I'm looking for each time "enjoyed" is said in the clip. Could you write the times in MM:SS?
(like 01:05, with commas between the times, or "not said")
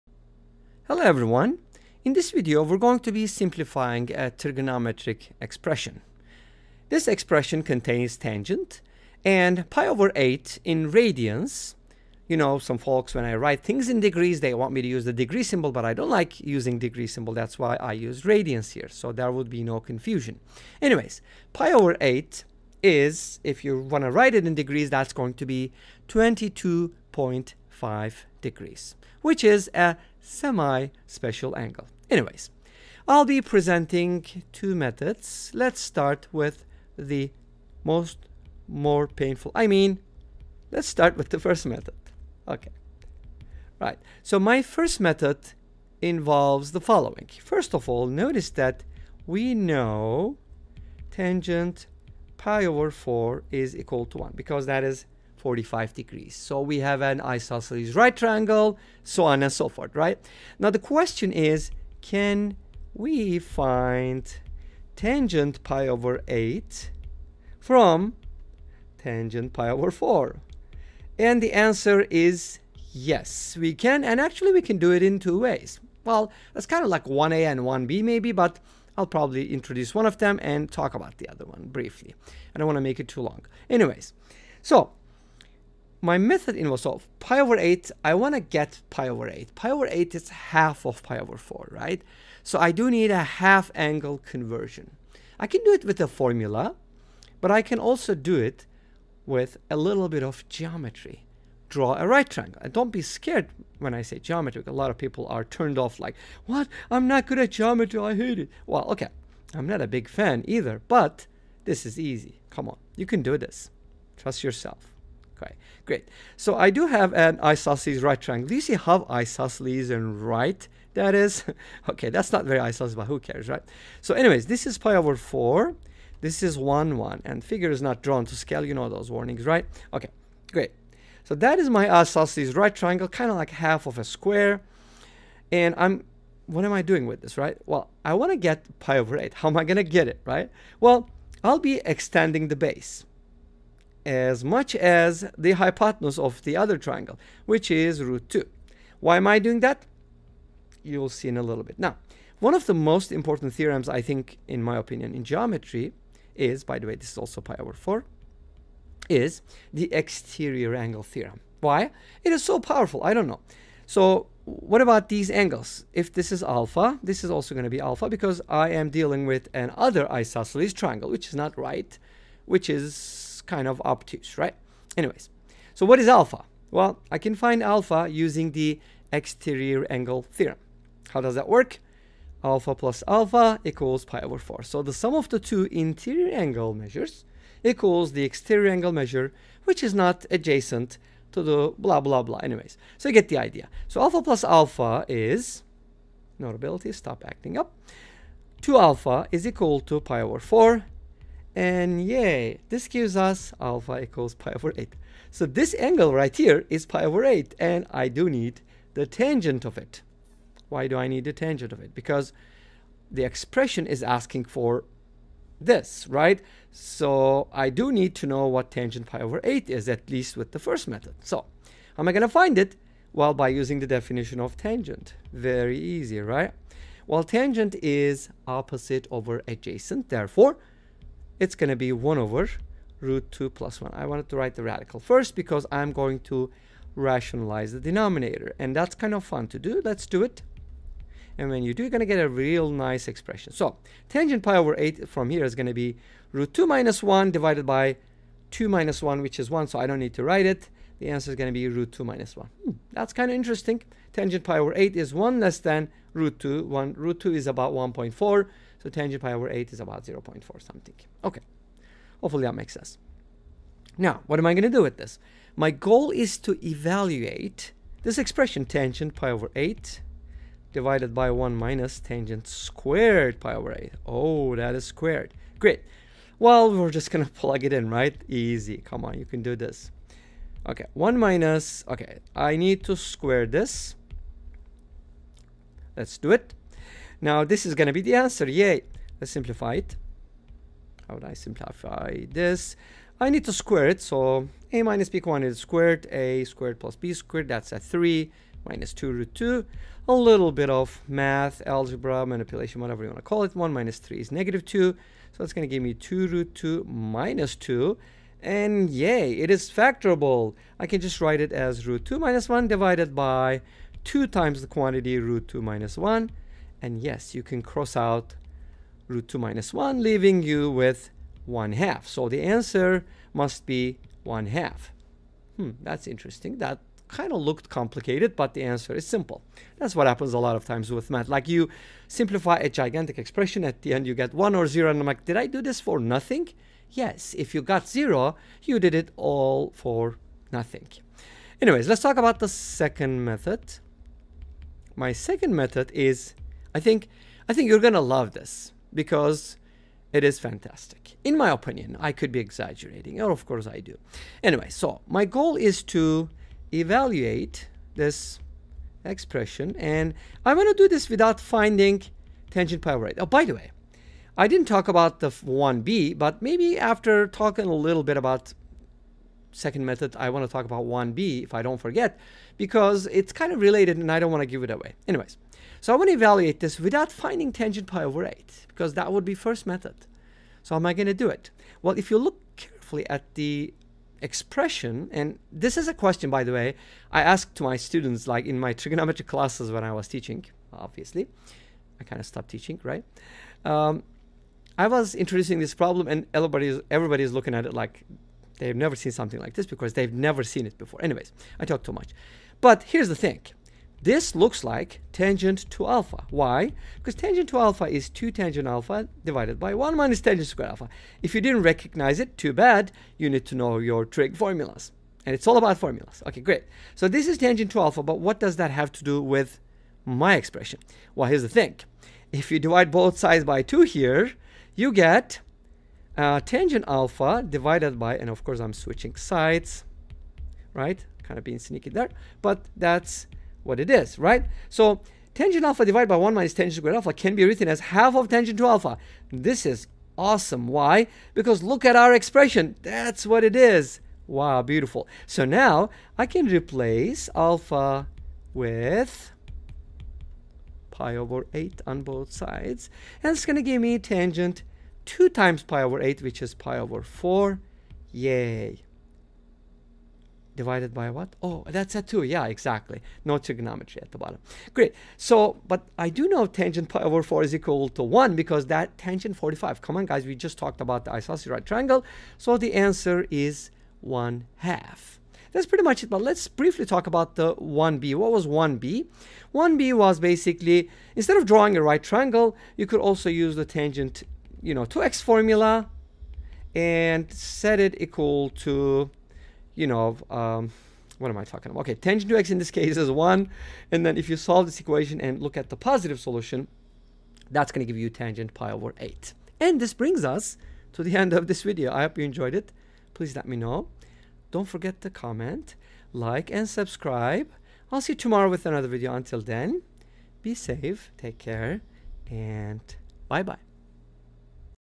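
08:22.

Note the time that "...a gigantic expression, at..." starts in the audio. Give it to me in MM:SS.
05:32.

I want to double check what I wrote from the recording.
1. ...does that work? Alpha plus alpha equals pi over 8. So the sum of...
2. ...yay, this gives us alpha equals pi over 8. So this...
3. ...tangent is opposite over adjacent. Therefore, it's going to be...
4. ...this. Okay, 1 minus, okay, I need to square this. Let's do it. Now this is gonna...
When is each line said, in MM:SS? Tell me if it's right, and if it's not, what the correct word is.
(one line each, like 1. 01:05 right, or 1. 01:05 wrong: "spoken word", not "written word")
1. 03:01 wrong: "4", not "8"
2. 03:22 right
3. 03:47 right
4. 04:39 right.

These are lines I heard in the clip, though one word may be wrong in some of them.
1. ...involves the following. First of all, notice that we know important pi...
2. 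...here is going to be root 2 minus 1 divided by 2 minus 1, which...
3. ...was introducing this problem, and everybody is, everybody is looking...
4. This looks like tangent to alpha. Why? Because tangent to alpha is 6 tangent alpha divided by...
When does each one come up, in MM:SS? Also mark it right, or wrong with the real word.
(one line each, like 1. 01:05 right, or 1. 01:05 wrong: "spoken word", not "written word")
1. 00:46 wrong: "tangent", not "important"
2. 04:05 right
3. 06:34 right
4. 06:44 wrong: "2", not "6".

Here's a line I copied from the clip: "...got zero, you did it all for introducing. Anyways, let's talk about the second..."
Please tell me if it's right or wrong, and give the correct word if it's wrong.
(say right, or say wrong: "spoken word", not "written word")
wrong: "nothing", not "introducing".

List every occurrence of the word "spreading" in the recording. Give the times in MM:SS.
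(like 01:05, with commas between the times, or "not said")
not said.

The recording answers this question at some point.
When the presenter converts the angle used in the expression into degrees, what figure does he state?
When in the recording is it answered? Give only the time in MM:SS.
00:26.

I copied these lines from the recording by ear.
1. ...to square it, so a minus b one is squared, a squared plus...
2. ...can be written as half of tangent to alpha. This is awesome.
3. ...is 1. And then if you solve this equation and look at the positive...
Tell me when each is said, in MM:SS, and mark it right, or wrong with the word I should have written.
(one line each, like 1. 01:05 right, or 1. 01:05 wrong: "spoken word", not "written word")
1. 04:53 right
2. 07:17 right
3. 08:12 right.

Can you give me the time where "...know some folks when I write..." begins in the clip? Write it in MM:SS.
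00:12.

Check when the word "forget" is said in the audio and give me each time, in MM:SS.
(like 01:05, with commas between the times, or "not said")
06:11, 08:24.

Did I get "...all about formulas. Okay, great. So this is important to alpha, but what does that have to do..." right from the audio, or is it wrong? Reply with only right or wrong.
wrong.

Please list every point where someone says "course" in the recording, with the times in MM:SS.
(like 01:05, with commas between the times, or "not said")
05:53, 07:08.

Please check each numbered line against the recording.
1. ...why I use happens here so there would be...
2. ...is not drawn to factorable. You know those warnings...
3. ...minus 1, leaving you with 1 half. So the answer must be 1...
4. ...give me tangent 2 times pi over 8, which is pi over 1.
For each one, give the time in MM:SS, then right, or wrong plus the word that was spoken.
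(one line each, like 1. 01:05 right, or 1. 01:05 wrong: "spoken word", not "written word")
1. 00:17 wrong: "radians", not "happens"
2. 02:07 wrong: "scale", not "factorable"
3. 05:19 right
4. 07:33 wrong: "4", not "1".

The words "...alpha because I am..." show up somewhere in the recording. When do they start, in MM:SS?
02:47.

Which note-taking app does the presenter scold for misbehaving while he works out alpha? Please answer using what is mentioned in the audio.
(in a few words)
Notability.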